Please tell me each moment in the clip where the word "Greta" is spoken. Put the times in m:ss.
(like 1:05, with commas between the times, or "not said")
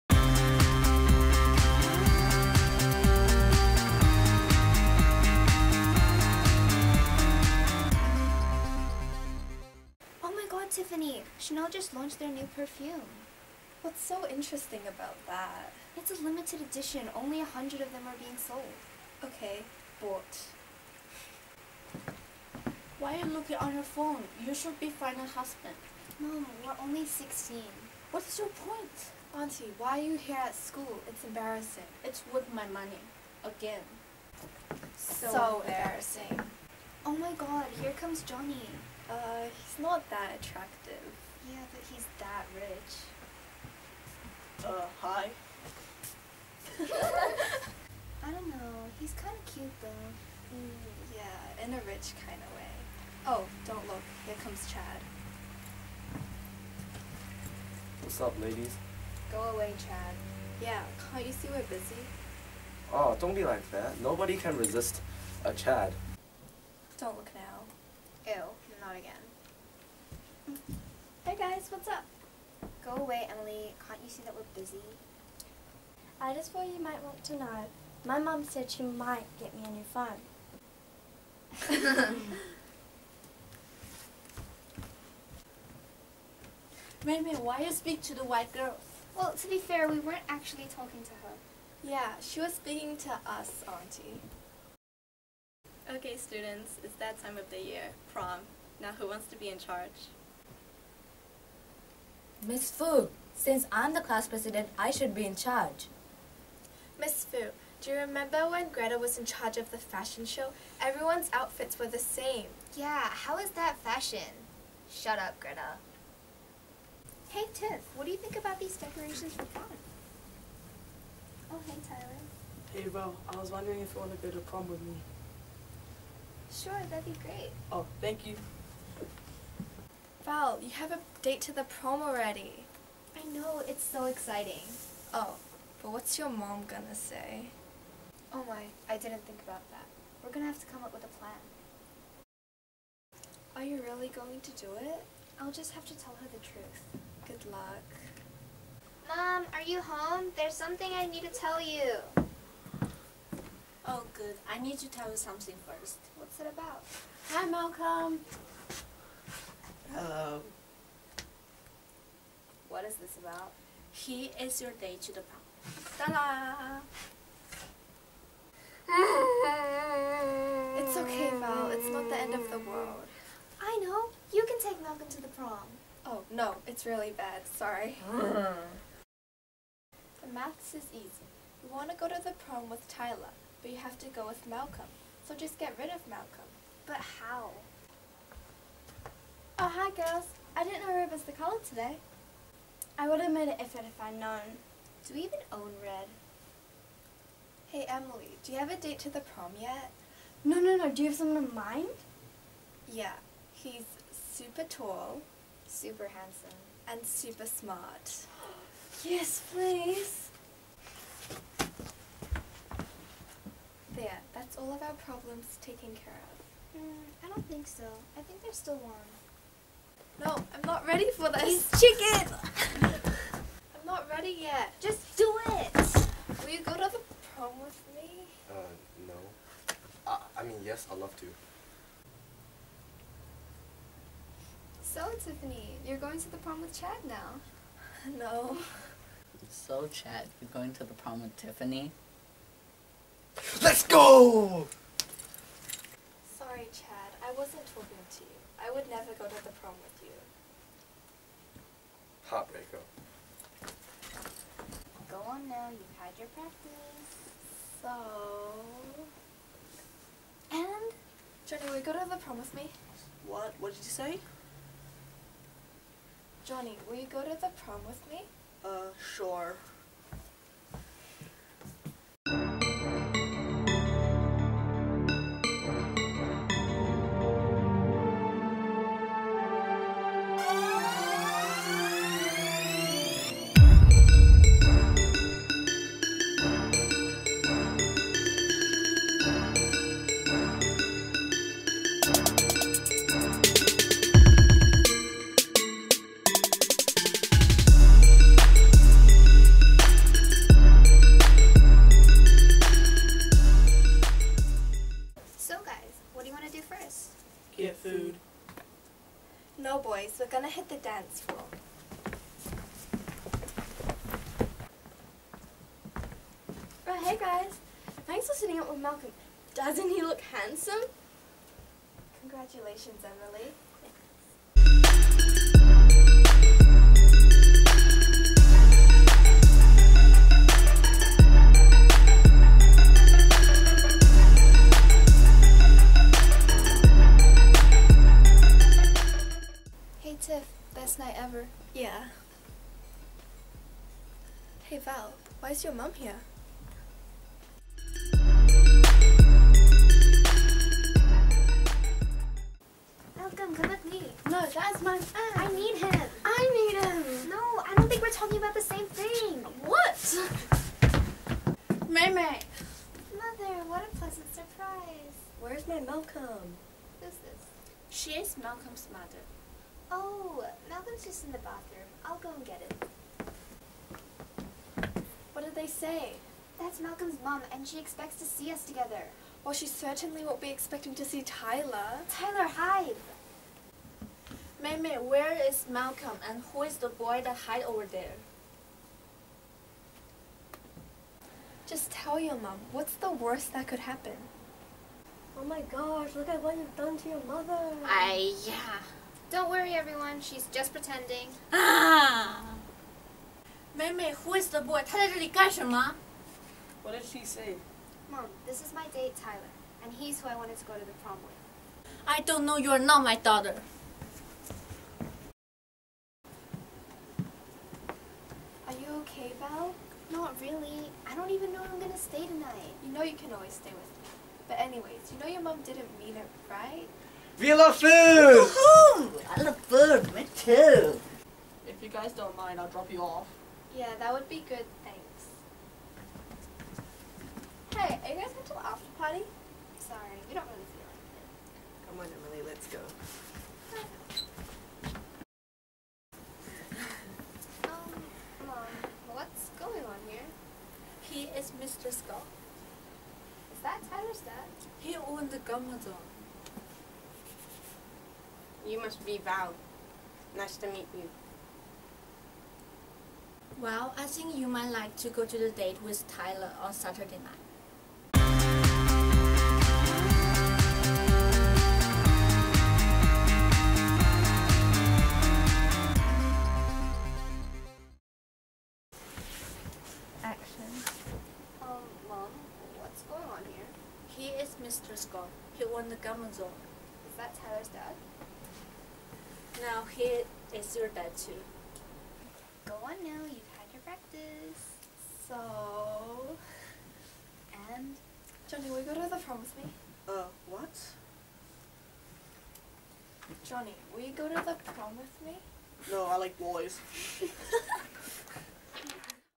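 1:48, 1:55.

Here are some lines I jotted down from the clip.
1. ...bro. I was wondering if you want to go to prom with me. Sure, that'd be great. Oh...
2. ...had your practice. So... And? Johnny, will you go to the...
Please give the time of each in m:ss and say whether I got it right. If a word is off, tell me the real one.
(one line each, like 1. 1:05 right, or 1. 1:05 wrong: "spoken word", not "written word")
1. 2:02 right
2. 4:15 right.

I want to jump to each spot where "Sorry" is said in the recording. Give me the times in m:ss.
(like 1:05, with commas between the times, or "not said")
2:57, 4:06, 7:19.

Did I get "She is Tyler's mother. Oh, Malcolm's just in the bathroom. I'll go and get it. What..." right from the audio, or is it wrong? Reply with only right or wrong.
wrong.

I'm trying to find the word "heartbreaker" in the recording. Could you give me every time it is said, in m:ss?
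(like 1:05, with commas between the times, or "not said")
4:12.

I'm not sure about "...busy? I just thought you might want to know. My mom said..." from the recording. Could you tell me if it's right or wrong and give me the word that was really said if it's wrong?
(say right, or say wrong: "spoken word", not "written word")
right.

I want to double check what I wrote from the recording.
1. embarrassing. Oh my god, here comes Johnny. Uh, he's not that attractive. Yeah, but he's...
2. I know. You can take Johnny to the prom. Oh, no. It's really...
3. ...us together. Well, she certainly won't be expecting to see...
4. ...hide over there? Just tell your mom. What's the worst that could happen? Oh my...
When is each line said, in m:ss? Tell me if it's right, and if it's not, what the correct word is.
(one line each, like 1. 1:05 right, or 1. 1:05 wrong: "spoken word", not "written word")
1. 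0:36 right
2. 2:53 wrong: "Malcolm", not "Johnny"
3. 6:18 right
4. 6:27 right.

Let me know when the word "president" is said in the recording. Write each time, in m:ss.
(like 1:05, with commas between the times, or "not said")
1:44.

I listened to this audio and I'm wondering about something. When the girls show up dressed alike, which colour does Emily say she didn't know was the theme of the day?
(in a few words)
Ruby.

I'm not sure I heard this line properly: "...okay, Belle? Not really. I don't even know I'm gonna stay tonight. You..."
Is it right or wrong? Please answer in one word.
right.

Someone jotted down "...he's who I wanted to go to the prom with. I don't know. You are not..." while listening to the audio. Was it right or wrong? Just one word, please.
right.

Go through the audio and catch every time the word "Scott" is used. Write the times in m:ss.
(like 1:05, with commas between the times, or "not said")
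7:31, 8:04.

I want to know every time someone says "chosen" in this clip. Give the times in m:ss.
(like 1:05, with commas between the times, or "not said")
not said.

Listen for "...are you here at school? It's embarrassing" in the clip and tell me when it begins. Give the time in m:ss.
0:29.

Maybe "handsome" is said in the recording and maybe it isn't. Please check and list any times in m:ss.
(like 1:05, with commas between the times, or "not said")
3:26, 5:20.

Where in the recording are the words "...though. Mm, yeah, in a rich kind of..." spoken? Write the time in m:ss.
0:49.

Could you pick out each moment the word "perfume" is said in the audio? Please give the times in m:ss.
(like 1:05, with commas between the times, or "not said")
0:12.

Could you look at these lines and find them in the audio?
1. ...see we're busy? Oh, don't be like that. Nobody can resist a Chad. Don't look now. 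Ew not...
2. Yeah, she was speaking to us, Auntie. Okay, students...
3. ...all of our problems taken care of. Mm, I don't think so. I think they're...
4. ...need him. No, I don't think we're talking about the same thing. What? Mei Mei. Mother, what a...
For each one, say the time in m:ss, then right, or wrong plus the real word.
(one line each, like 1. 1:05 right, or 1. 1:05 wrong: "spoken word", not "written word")
1. 1:01 right
2. 1:31 right
3. 3:34 right
4. 5:56 right.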